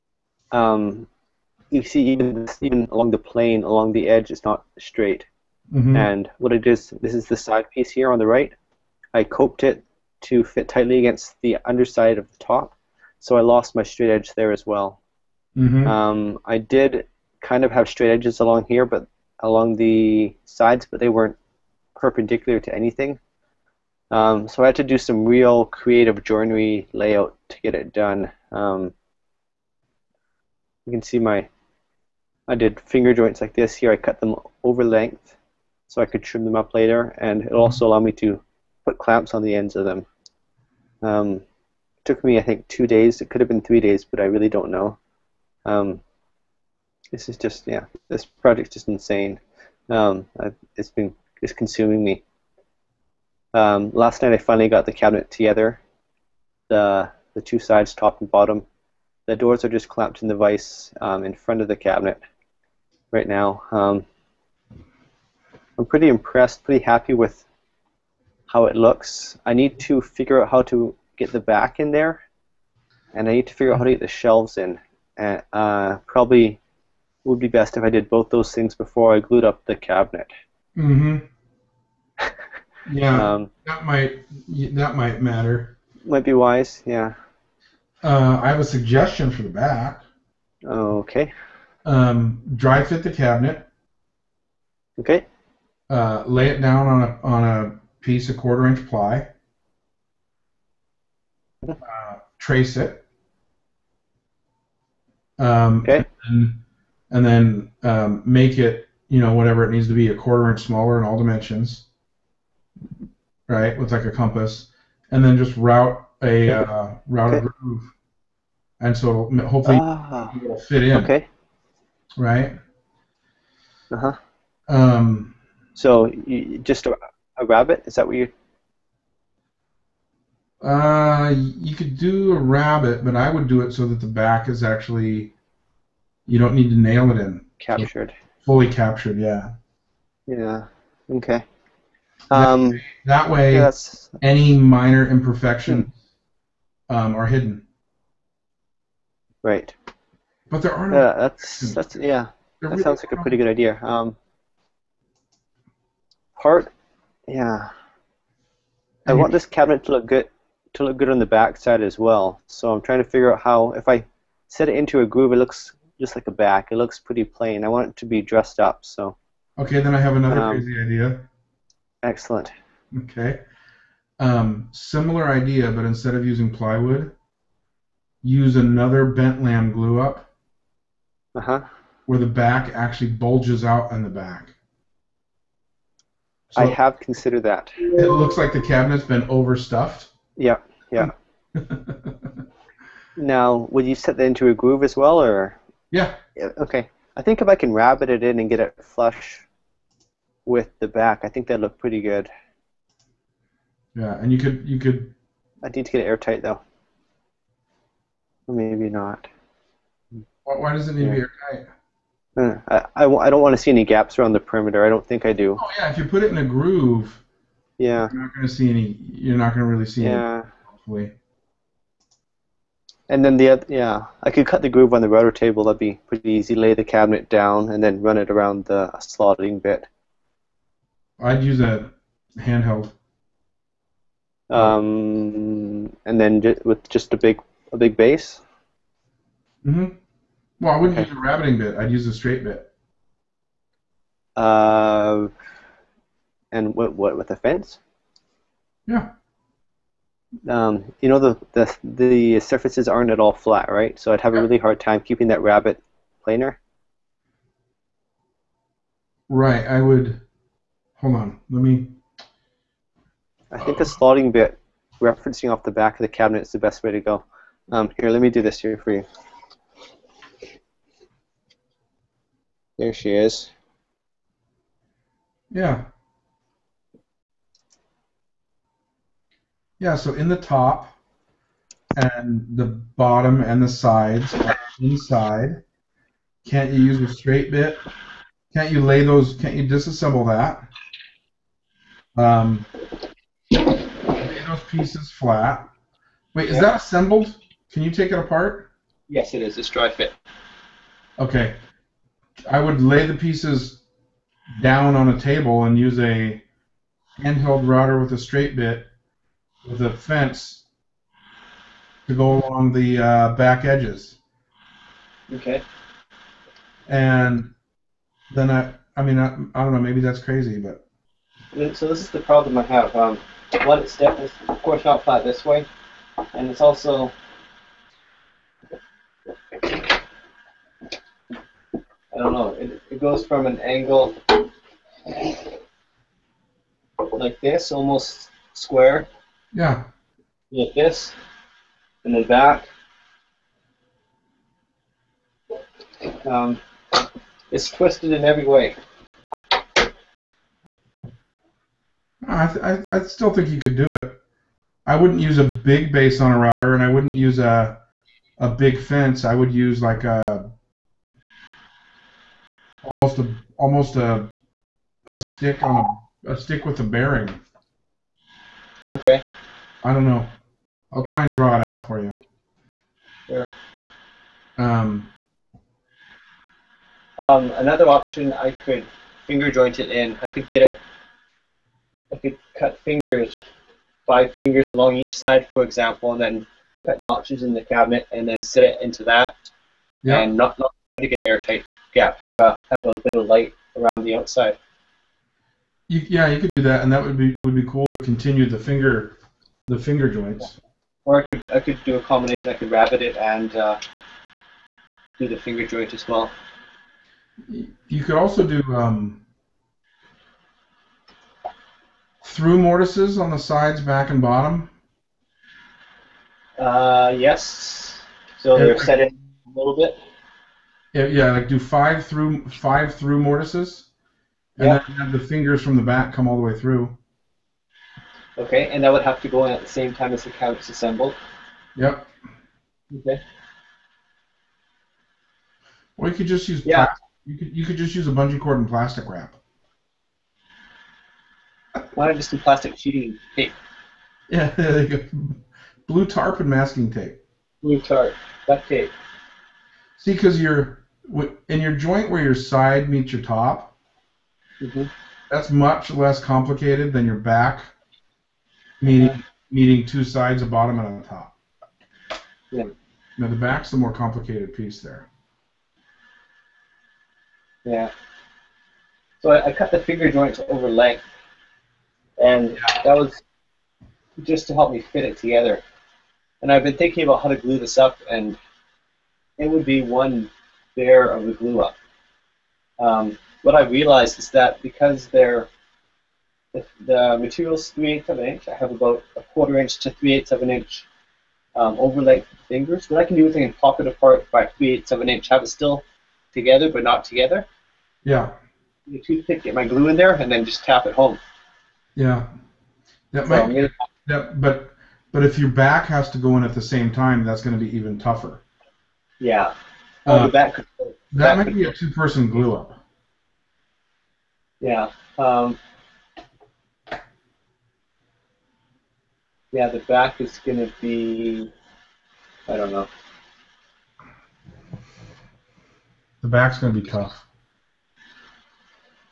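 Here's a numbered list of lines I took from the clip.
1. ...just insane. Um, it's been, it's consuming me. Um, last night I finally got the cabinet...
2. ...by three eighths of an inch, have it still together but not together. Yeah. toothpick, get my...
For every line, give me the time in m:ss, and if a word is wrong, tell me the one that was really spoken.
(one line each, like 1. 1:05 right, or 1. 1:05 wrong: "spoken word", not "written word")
1. 0:48 right
2. 8:14 right.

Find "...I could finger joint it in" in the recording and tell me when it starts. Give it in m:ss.
6:18.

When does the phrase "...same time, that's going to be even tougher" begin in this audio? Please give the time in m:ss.
8:26.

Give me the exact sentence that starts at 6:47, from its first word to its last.
You could also do um, through mortises on the sides, back, and bottom.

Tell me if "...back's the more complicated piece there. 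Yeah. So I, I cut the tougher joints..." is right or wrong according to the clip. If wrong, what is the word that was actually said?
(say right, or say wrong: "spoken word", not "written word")
wrong: "finger", not "tougher".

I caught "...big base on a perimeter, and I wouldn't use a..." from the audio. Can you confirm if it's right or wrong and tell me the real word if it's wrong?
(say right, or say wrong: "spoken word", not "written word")
wrong: "router", not "perimeter".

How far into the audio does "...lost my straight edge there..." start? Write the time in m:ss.
0:13.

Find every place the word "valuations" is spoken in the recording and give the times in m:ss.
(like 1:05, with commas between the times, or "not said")
not said.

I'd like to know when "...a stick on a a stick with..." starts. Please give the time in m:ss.
6:05.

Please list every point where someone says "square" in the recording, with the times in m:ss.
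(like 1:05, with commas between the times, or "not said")
5:38.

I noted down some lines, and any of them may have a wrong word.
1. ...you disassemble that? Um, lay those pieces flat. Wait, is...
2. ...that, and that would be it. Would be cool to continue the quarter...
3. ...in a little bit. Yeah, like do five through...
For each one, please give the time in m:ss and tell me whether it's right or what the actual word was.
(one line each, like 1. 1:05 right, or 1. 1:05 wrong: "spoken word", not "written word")
1. 4:49 right
2. 6:36 wrong: "finger", not "quarter"
3. 6:58 right.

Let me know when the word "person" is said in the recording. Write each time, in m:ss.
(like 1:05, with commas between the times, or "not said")
8:31.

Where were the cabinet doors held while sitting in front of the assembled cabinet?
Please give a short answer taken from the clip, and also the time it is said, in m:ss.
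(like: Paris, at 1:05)
in the vise, at 1:00.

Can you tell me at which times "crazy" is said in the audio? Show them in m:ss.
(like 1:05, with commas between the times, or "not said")
2:50, 5:20.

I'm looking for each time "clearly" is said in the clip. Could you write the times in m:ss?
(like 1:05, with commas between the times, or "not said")
not said.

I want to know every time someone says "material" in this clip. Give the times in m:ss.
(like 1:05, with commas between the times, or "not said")
8:07.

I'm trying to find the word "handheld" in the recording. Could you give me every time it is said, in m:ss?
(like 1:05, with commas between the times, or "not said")
3:52, 5:07.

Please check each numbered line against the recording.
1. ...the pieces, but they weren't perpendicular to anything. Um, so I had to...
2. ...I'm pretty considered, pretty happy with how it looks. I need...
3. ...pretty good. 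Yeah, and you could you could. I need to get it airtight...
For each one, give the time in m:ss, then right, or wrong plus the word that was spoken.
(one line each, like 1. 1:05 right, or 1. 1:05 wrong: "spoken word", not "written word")
1. 0:19 wrong: "sides", not "pieces"
2. 1:05 wrong: "impressed", not "considered"
3. 3:21 right.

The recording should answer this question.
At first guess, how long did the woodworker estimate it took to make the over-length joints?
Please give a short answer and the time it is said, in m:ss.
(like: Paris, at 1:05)
two days, at 0:42.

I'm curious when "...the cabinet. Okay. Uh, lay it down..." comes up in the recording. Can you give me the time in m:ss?
1:33.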